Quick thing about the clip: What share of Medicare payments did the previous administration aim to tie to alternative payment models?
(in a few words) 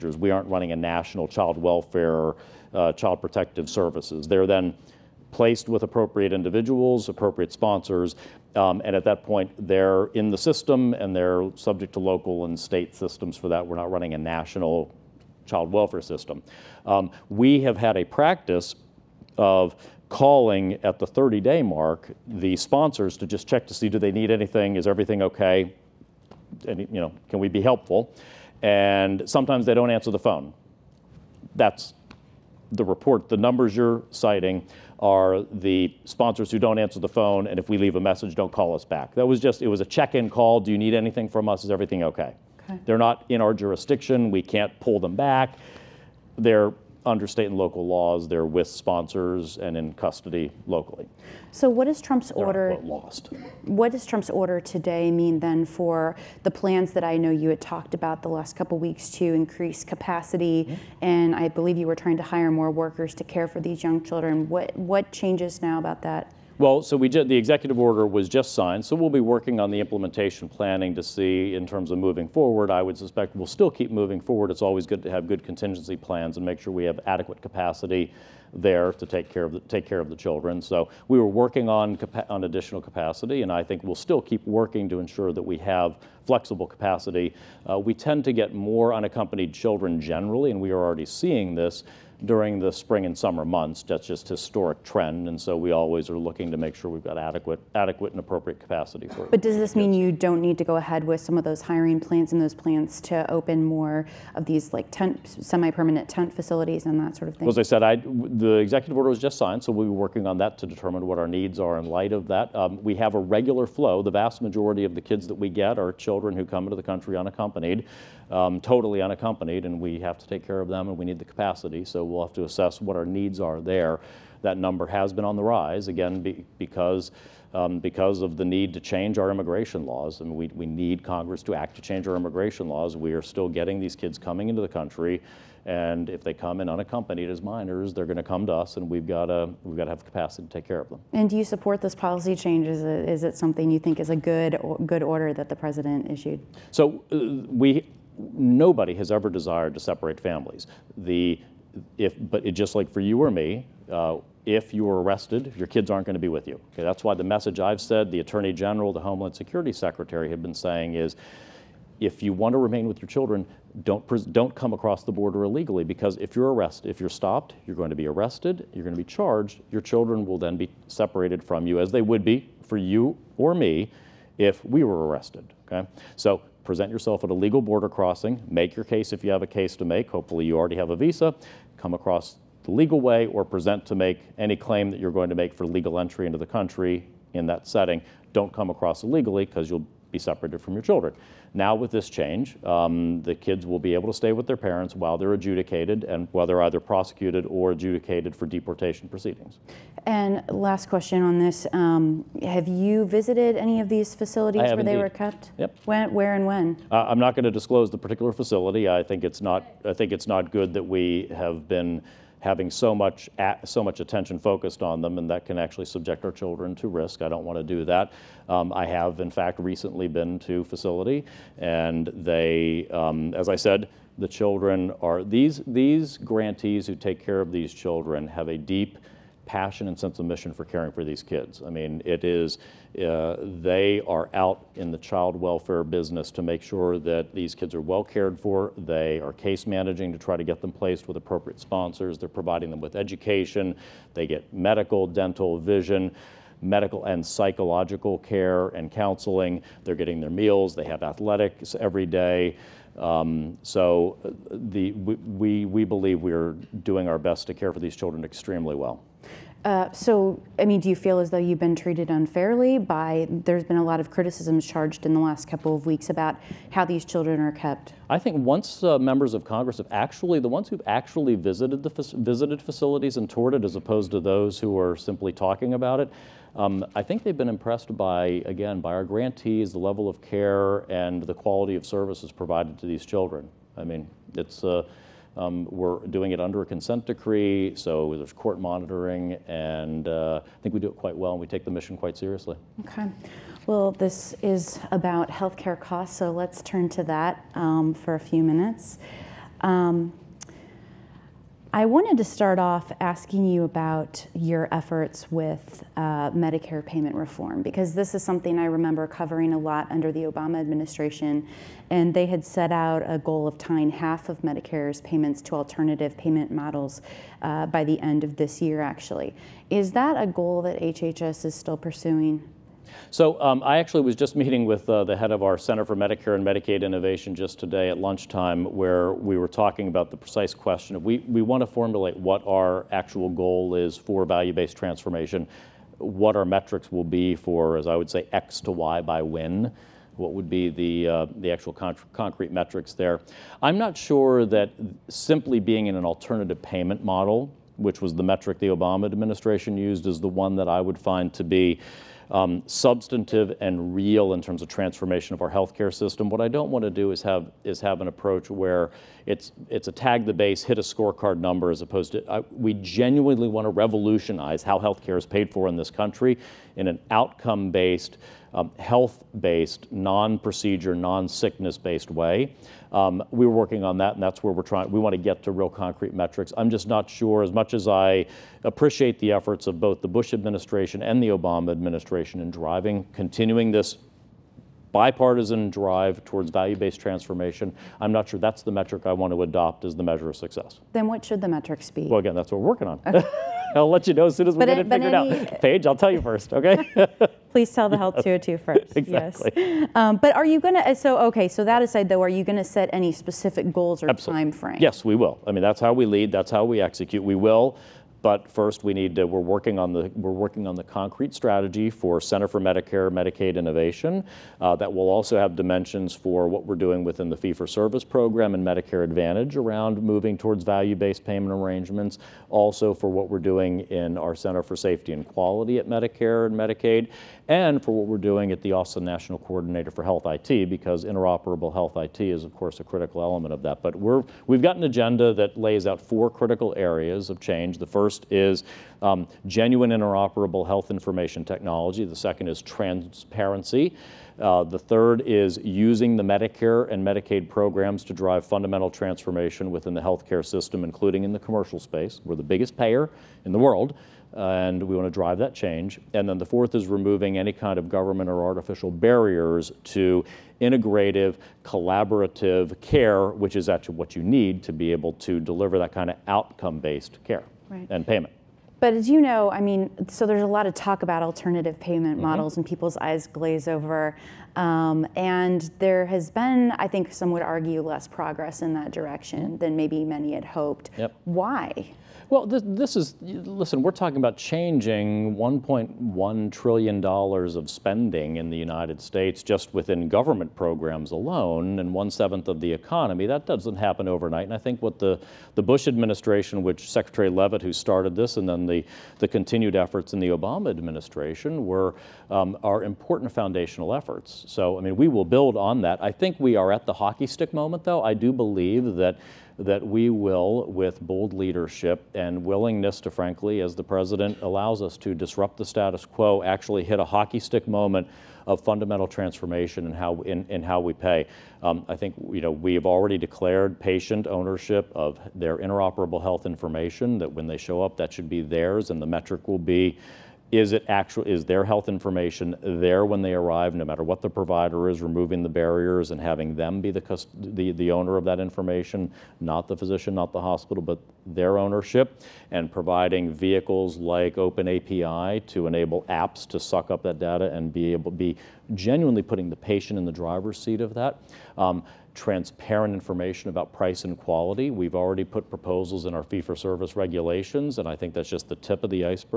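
half.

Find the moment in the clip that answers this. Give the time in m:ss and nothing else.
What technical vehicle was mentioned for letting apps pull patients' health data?
9:04.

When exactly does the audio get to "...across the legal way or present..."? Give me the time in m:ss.
3:01.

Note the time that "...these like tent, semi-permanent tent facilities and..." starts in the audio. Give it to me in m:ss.
1:44.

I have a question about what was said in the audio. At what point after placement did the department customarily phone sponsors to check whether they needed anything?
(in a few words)
30 day mark.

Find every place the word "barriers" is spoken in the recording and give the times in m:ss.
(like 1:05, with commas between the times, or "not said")
7:38, 8:55.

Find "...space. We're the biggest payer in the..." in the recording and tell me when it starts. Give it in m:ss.
7:31.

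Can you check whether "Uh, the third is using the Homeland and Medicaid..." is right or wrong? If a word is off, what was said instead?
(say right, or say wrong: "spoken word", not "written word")
wrong: "Medicare", not "Homeland".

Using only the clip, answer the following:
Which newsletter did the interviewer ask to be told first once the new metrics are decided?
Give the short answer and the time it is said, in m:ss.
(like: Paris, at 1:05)
Health 202, at 6:37.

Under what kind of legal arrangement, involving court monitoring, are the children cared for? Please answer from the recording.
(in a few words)
consent decree.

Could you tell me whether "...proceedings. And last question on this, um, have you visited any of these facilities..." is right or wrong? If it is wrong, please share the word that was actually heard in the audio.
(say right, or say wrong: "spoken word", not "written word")
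right.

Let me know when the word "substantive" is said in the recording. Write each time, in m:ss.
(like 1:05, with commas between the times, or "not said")
5:52.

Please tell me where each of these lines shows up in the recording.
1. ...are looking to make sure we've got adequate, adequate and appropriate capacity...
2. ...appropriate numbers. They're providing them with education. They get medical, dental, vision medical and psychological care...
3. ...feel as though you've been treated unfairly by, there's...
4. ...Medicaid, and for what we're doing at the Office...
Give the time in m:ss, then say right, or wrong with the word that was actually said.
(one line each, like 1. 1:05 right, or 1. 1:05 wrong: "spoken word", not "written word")
1. 1:36 right
2. 4:01 wrong: "sponsors", not "numbers"
3. 4:20 right
4. 7:06 right.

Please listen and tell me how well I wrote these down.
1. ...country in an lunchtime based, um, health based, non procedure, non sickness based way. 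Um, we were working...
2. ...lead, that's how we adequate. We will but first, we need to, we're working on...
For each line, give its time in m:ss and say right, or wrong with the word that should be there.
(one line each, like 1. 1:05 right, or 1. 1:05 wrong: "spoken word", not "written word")
1. 6:05 wrong: "outcome", not "lunchtime"
2. 6:46 wrong: "execute", not "adequate".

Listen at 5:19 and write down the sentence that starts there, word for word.
Is that a goal that HHS is still pursuing?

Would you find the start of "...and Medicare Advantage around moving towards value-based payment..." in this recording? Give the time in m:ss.
6:58.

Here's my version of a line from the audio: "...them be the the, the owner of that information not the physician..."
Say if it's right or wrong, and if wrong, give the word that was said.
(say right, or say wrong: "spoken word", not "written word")
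right.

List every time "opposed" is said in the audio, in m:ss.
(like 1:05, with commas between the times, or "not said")
4:33, 6:01.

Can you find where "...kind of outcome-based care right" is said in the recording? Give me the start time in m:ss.
7:45.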